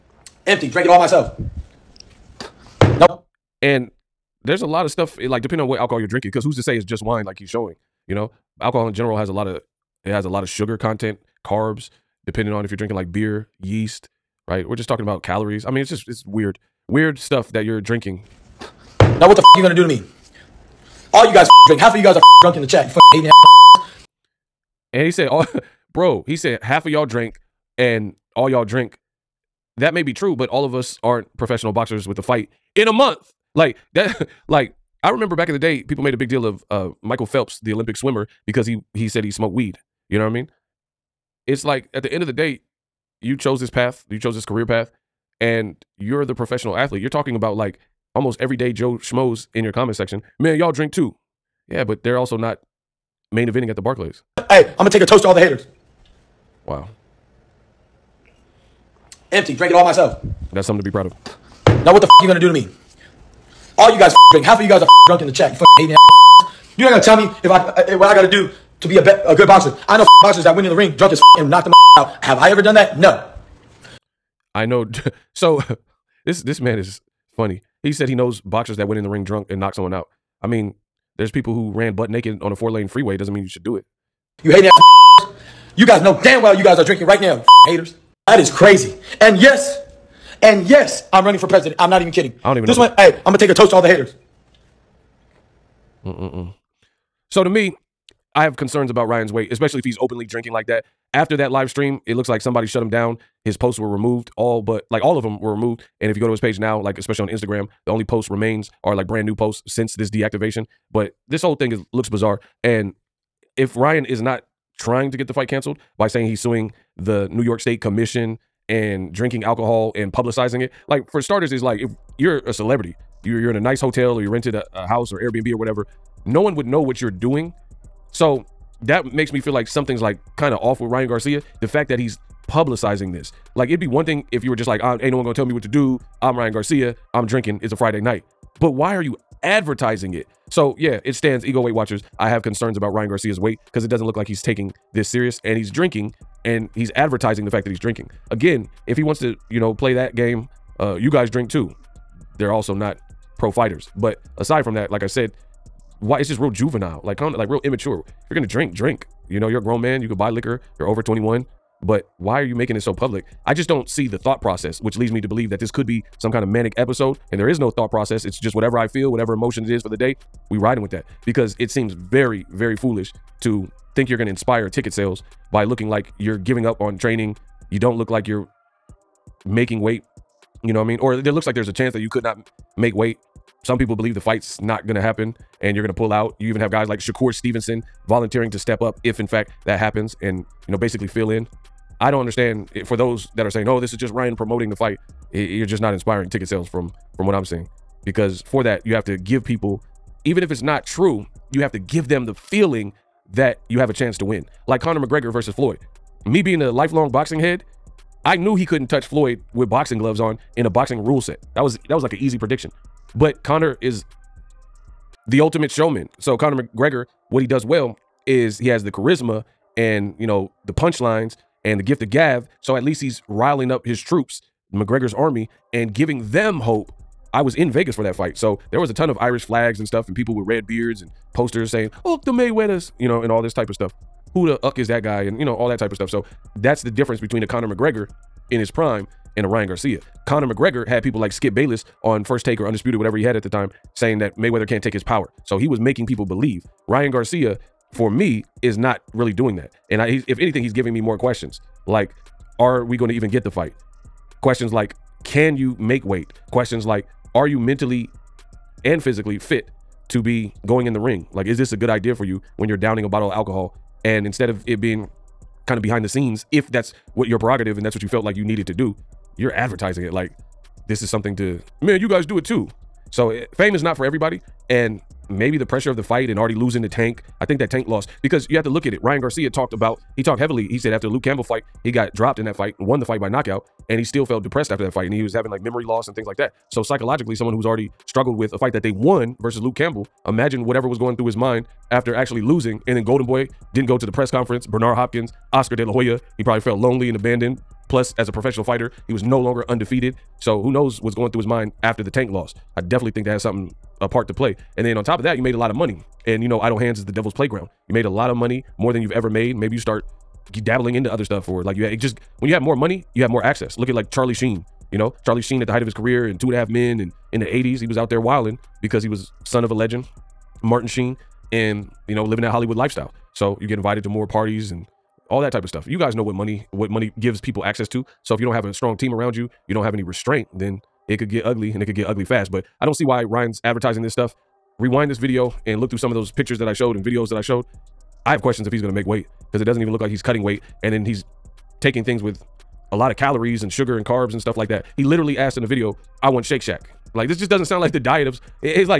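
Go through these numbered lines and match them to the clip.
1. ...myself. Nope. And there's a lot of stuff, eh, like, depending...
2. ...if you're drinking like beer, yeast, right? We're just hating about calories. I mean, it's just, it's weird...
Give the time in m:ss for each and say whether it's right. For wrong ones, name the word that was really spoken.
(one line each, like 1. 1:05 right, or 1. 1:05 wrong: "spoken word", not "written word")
1. 0:00 right
2. 0:12 wrong: "talking", not "hating".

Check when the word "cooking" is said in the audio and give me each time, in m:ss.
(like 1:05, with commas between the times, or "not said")
not said.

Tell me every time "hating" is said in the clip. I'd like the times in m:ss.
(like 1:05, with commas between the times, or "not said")
0:23, 1:05.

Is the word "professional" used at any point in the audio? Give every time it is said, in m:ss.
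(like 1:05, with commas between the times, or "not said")
0:31, 0:46, 4:58.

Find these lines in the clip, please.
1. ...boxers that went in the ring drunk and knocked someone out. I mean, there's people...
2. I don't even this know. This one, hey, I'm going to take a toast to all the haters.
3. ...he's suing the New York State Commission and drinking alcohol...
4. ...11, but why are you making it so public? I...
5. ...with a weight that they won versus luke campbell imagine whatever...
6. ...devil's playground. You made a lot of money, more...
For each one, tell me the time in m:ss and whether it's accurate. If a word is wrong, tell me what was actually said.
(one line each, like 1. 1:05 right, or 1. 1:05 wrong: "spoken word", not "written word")
1. 1:18 right
2. 1:32 right
3. 1:56 right
4. 2:41 wrong: "21", not "11"
5. 4:48 wrong: "fight", not "weight"
6. 5:07 right.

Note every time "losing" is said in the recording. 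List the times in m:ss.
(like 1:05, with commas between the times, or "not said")
4:36, 4:52.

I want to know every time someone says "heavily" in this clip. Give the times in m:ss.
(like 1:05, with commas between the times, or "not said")
4:40.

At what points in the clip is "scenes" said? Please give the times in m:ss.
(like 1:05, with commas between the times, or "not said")
4:26.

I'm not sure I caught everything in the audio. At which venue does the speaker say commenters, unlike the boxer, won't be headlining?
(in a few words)
Barclays.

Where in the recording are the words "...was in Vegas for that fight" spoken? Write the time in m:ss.
3:47.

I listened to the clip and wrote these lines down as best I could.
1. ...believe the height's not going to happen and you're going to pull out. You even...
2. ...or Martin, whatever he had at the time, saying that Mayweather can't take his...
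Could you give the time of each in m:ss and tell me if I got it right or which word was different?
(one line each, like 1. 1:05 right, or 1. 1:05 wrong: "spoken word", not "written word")
1. 3:03 wrong: "fight", not "height"
2. 4:02 wrong: "Undisputed", not "Martin".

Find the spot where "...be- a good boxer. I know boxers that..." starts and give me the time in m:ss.
1:09.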